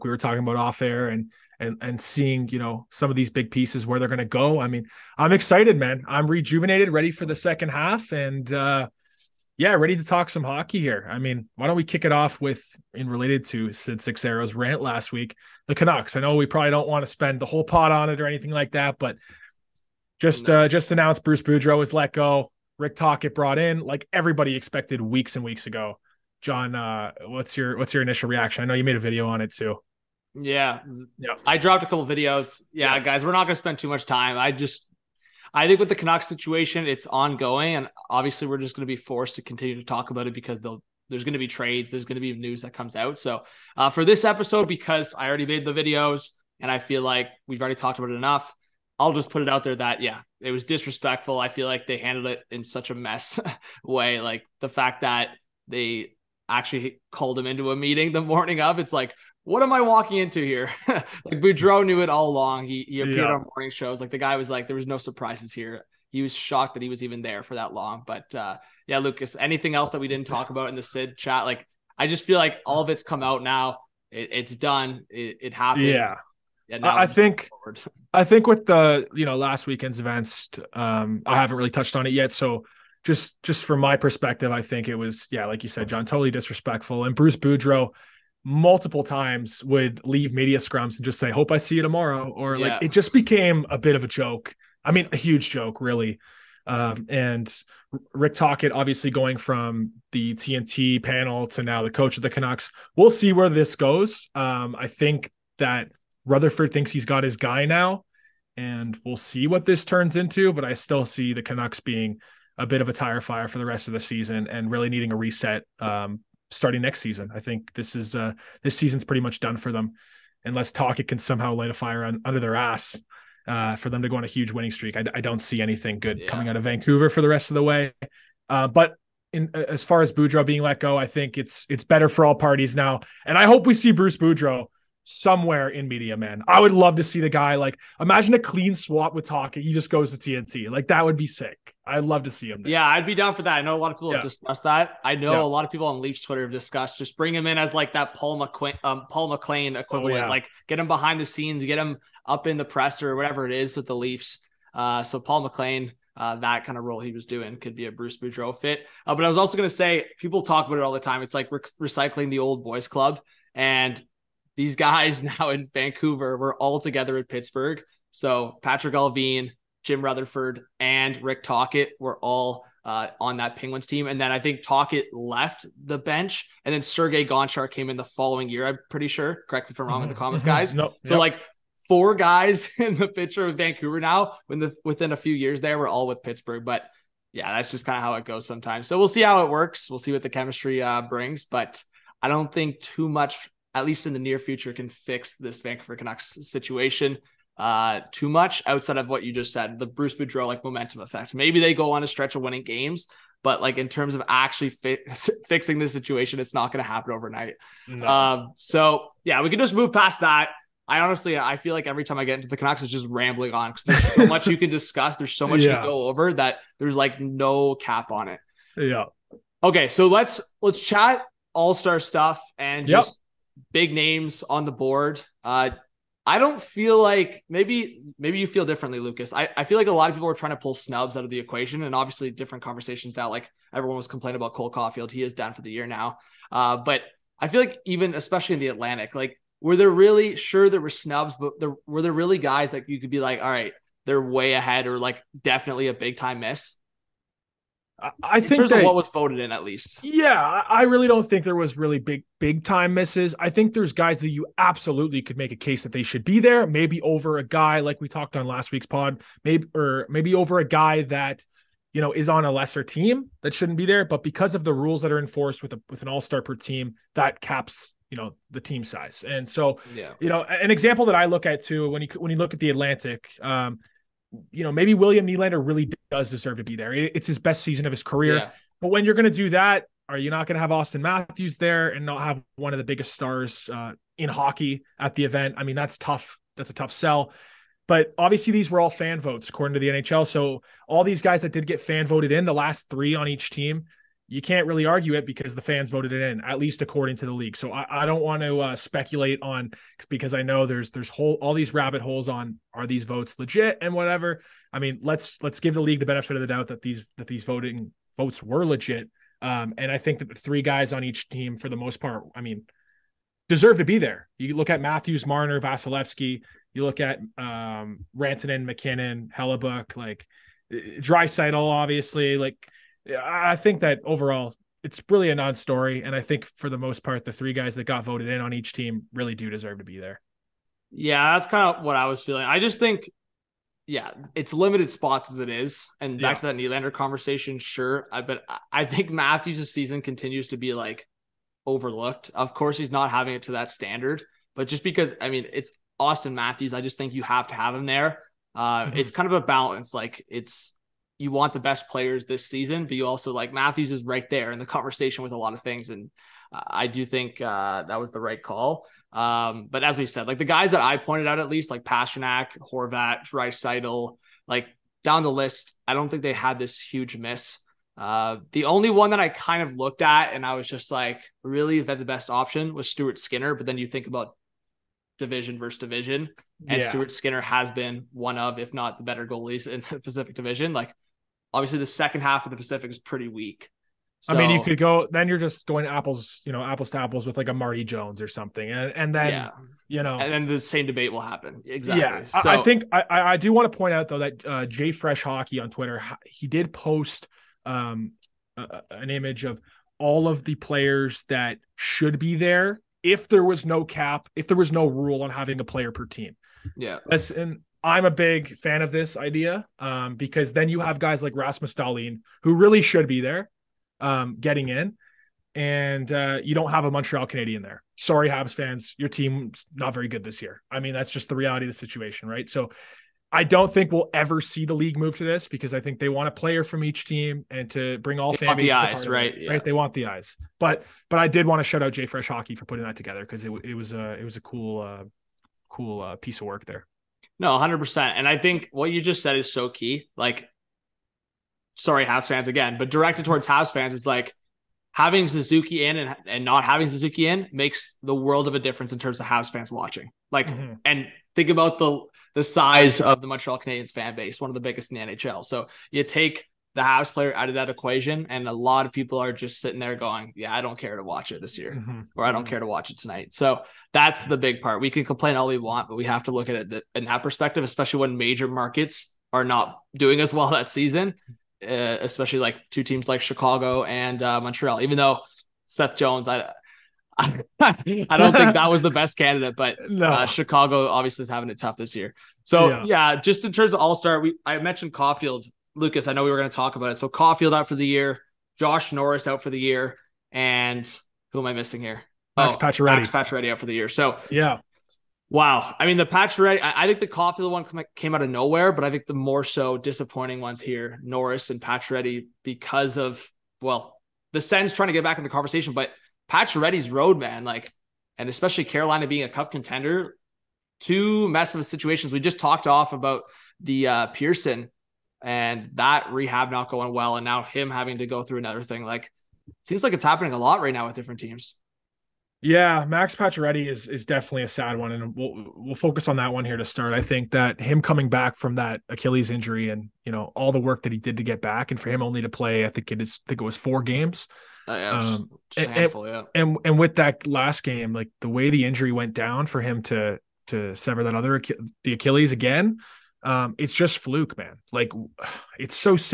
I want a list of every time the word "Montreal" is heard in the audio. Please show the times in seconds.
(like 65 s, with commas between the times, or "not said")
416 s, 453 s, 474 s.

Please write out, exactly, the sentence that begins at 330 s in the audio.
Yeah, that's kind of what I was feeling.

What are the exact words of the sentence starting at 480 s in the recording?
uh, Chicago obviously is having it tough this year.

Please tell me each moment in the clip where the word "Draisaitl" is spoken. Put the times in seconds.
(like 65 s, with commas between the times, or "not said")
320 s, 363 s.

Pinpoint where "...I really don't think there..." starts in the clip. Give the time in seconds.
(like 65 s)
250 s.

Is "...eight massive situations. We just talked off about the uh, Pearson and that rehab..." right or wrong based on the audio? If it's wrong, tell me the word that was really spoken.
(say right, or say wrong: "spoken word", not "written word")
wrong: "two", not "eight".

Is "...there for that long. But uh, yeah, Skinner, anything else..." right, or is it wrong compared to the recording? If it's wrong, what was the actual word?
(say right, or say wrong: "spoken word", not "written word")
wrong: "Lucas", not "Skinner".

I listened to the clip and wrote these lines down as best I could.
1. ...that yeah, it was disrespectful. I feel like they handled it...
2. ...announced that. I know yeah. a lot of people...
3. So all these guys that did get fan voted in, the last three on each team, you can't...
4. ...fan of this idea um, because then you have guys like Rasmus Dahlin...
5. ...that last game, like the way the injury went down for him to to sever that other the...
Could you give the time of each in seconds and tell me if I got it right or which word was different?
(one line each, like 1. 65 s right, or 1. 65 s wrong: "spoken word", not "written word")
1. 49 s right
2. 144 s wrong: "discussed", not "announced"
3. 290 s right
4. 408 s right
5. 536 s right.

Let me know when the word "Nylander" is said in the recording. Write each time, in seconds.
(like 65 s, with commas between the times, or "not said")
275 s, 336 s.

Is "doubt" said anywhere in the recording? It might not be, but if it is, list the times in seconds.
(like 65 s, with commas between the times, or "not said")
306 s.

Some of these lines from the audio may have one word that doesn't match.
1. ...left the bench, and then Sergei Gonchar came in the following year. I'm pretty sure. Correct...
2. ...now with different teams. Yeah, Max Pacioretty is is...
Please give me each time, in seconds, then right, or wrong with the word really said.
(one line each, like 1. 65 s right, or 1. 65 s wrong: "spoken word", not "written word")
1. 175 s right
2. 520 s right.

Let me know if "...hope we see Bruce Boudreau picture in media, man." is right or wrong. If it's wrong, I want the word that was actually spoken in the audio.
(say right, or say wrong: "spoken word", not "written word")
wrong: "somewhere", not "picture".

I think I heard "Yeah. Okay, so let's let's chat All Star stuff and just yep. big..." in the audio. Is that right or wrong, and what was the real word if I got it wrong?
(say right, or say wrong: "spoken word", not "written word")
right.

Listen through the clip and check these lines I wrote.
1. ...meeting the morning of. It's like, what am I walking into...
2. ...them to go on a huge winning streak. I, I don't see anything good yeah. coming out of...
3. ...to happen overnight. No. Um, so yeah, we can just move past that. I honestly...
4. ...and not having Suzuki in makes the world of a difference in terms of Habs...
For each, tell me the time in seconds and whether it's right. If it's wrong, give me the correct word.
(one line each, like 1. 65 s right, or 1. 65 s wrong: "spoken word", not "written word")
1. 57 s right
2. 123 s right
3. 206 s right
4. 446 s right.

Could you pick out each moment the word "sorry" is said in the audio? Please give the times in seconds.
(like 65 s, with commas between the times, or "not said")
417 s, 441 s.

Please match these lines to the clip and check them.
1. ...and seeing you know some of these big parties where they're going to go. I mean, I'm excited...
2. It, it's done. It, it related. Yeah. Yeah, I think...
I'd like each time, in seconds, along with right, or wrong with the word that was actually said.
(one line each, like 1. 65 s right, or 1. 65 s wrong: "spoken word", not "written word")
1. 1 s wrong: "pieces", not "parties"
2. 74 s wrong: "happened", not "related".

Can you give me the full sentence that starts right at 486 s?
So Caufield out for the year, Josh Norris out for the year, and who am I missing here?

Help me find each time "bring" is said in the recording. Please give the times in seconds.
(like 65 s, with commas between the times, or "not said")
147 s, 191 s, 427 s.